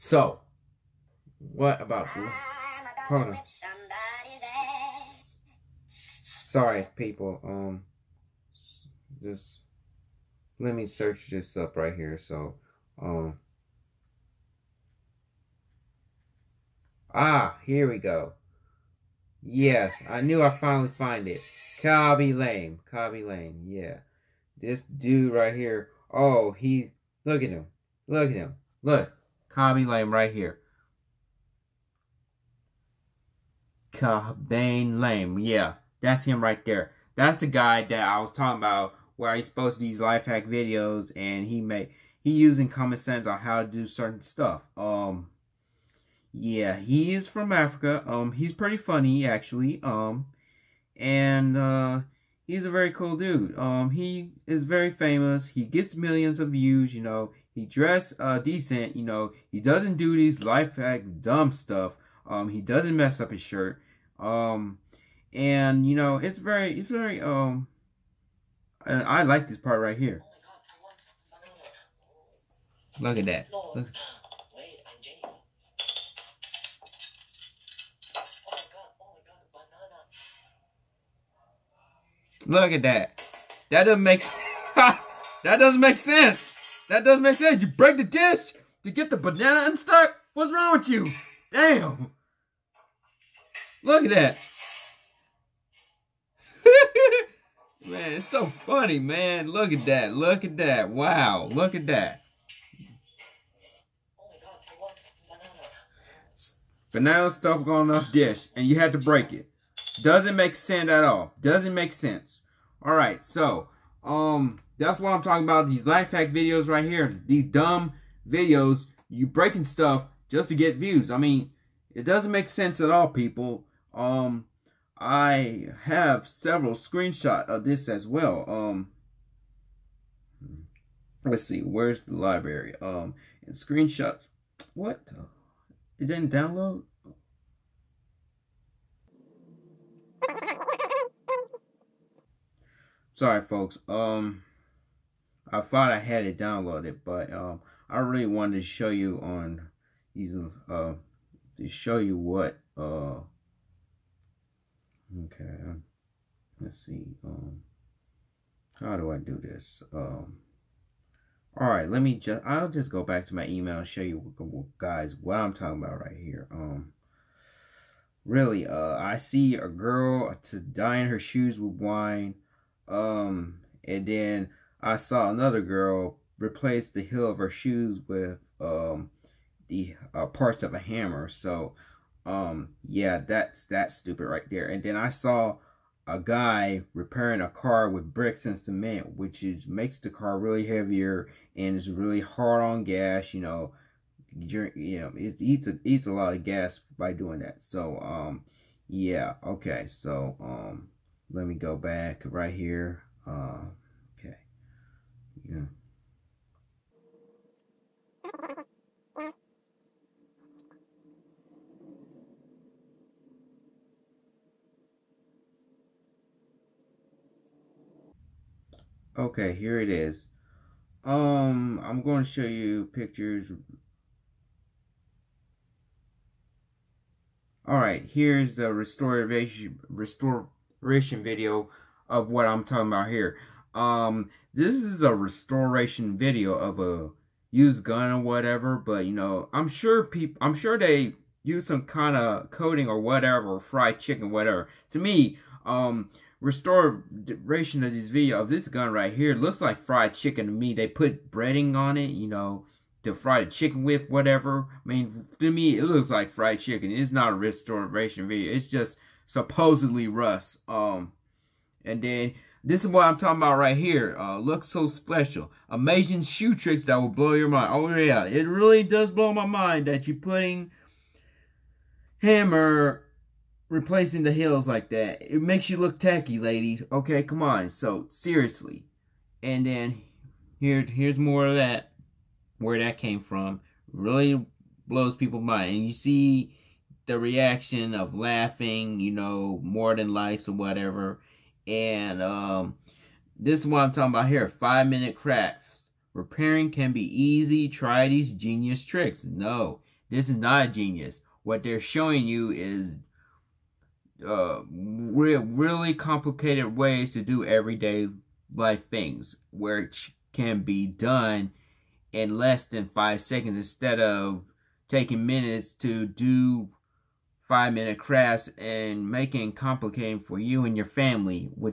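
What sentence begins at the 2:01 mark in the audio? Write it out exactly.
I mean, it doesn't make sense at all, people.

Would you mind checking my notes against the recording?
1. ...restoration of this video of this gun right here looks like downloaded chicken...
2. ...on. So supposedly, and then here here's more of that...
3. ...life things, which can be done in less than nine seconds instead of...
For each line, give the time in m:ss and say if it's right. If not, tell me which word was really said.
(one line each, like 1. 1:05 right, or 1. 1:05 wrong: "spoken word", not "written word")
1. 4:06 wrong: "fried", not "downloaded"
2. 4:37 wrong: "seriously", not "supposedly"
3. 5:08 wrong: "five", not "nine".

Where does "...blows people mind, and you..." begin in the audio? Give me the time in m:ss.
4:44.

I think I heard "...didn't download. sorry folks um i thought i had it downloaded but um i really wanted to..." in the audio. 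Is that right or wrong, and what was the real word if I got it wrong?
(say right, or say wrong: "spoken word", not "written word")
right.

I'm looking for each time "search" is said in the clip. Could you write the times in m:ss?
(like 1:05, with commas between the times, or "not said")
0:10.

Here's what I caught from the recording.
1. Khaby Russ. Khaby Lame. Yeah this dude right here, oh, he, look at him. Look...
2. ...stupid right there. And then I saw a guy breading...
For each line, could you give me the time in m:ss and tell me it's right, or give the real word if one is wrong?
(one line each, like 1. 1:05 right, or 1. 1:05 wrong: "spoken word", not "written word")
1. 0:21 wrong: "Lame", not "Russ"
2. 3:03 wrong: "repairing", not "breading".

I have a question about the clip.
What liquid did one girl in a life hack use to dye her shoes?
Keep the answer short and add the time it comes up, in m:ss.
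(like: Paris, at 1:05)
Wine, at 2:51.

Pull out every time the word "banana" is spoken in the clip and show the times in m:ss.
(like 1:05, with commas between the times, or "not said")
1:29, 1:46.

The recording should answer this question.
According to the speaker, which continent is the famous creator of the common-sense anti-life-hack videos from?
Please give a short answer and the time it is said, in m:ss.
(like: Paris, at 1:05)
Africa, at 0:47.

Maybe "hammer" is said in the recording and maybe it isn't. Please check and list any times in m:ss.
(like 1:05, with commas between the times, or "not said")
3:00, 4:32.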